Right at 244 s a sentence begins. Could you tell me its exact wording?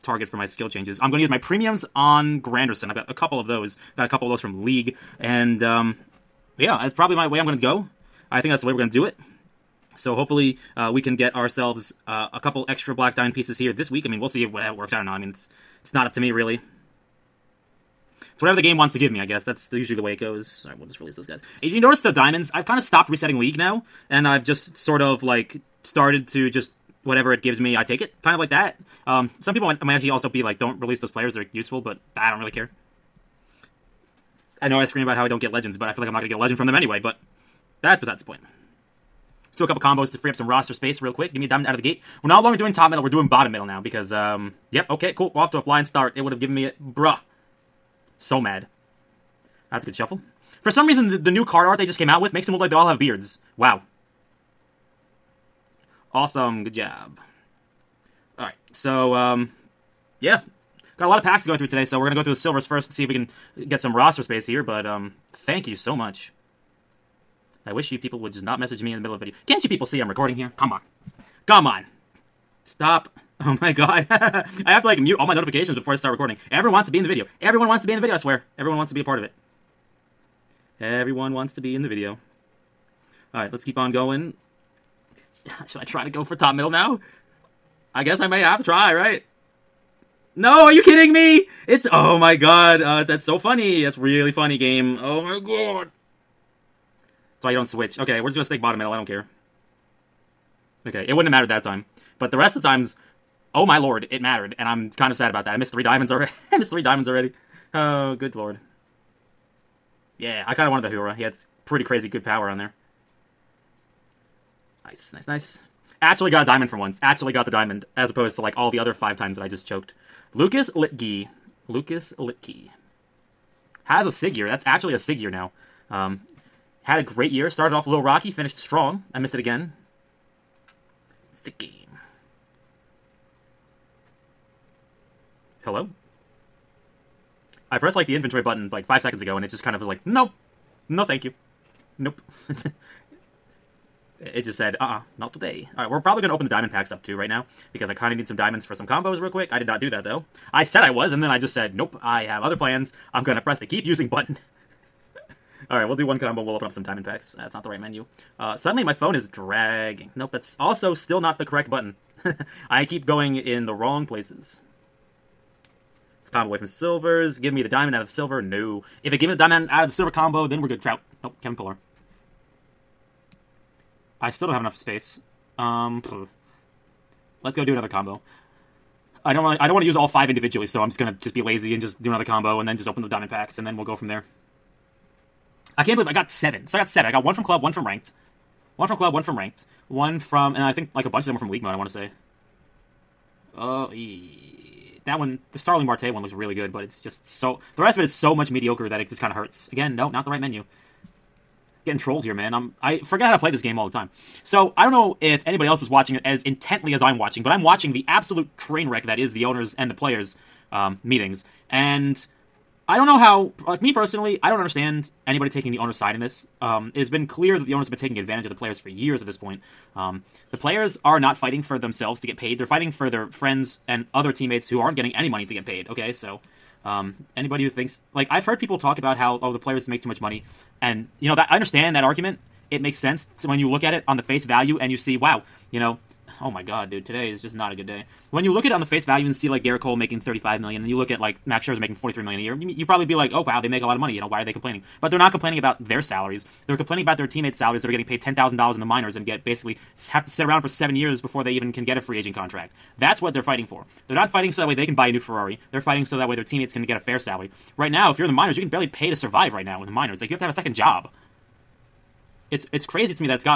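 You know, why are they complaining?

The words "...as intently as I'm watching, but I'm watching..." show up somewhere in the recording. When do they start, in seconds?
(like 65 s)
206 s.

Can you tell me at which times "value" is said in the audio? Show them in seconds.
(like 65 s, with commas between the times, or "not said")
234 s, 239 s.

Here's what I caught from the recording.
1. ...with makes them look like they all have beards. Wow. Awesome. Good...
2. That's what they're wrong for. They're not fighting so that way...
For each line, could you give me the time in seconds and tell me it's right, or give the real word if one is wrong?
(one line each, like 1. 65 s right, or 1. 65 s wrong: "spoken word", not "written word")
1. 52 s right
2. 252 s wrong: "fighting", not "wrong".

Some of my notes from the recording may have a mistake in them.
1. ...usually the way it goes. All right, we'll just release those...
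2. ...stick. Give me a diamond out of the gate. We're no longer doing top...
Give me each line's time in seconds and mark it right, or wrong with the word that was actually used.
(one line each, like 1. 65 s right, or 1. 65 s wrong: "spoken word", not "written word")
1. 19 s right
2. 41 s wrong: "quick", not "stick".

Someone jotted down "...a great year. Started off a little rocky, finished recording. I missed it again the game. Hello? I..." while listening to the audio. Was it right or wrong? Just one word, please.
wrong.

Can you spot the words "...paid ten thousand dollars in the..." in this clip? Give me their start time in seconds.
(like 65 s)
248 s.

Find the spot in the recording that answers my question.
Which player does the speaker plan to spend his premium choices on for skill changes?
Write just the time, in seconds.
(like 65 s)
2 s.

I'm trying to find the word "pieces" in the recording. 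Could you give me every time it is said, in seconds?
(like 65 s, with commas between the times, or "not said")
13 s.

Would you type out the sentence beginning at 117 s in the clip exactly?
Actually got the diamond, as opposed to like all the other five times that I just choked.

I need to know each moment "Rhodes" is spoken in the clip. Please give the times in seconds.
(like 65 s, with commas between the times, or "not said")
not said.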